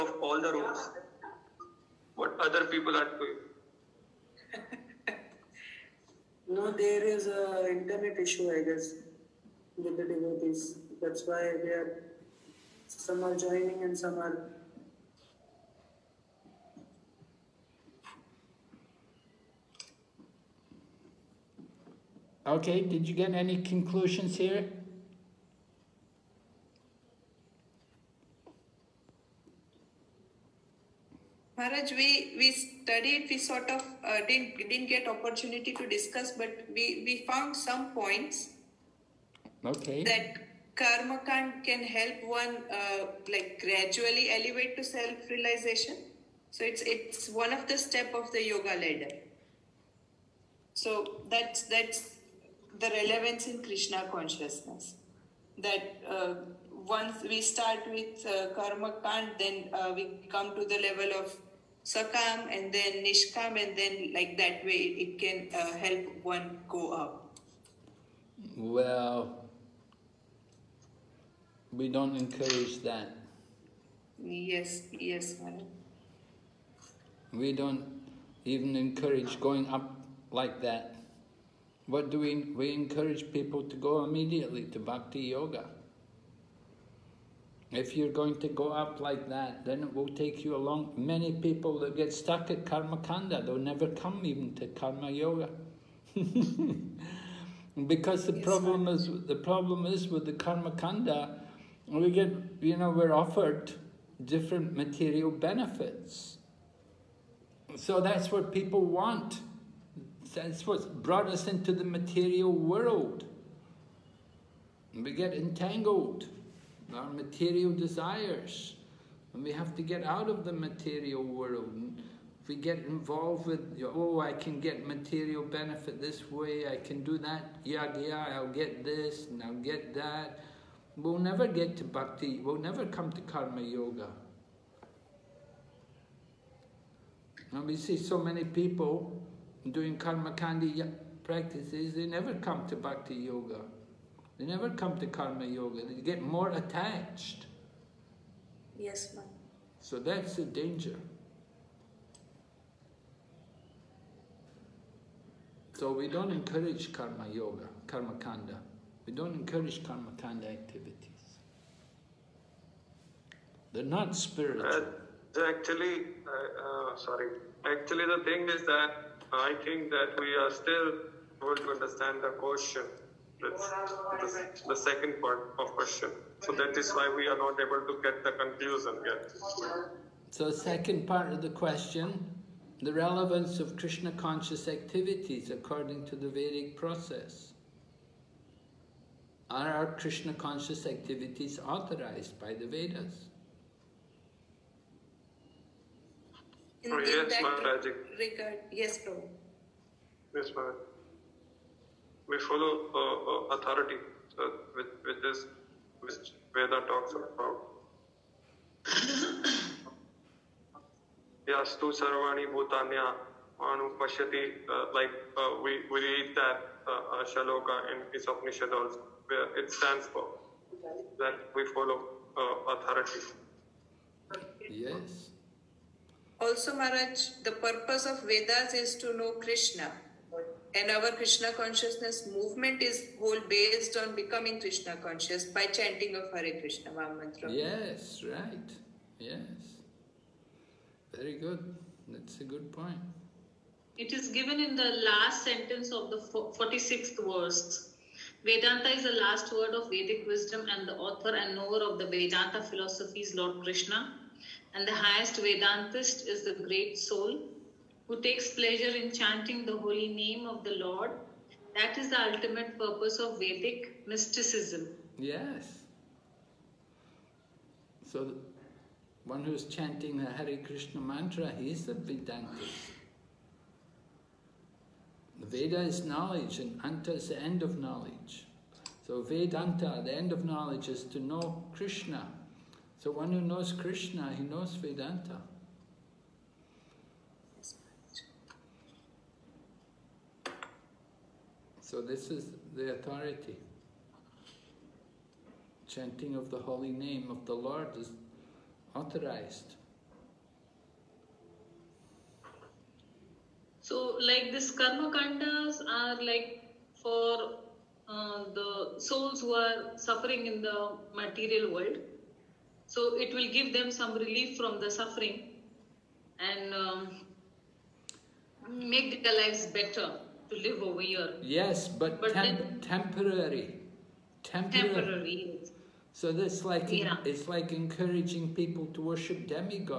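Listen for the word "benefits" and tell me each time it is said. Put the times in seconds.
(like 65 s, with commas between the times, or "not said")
105 s, 125 s.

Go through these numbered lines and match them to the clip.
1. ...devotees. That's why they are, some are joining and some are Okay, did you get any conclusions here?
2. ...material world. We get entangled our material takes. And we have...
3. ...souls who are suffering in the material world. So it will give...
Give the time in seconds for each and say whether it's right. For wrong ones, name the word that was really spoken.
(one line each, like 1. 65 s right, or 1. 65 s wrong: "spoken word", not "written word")
1. 10 s right
2. 111 s wrong: "desires", not "takes"
3. 308 s right.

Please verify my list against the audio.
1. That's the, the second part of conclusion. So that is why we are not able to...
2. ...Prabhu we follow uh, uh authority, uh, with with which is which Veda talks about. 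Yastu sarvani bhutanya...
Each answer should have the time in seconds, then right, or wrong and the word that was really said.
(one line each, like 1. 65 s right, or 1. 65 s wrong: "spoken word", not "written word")
1. 173 s wrong: "question", not "conclusion"
2. 200 s right.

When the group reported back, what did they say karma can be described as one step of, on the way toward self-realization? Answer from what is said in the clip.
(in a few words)
the yoga ladder.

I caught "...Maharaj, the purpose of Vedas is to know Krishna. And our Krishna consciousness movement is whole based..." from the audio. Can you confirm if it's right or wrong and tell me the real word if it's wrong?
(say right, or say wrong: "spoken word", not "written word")
right.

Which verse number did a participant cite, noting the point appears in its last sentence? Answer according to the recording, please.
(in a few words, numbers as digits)
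46.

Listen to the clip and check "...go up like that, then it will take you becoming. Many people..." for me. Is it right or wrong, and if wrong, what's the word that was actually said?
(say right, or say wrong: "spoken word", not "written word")
wrong: "along", not "becoming".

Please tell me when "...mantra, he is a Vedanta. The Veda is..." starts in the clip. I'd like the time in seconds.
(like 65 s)
271 s.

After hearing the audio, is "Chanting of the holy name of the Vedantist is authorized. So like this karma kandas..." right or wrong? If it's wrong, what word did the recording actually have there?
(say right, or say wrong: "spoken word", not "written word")
wrong: "Lord", not "Vedantist".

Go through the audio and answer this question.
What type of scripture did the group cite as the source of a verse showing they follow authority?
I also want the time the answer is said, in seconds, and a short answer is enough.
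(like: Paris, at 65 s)
Upanishad, at 218 s.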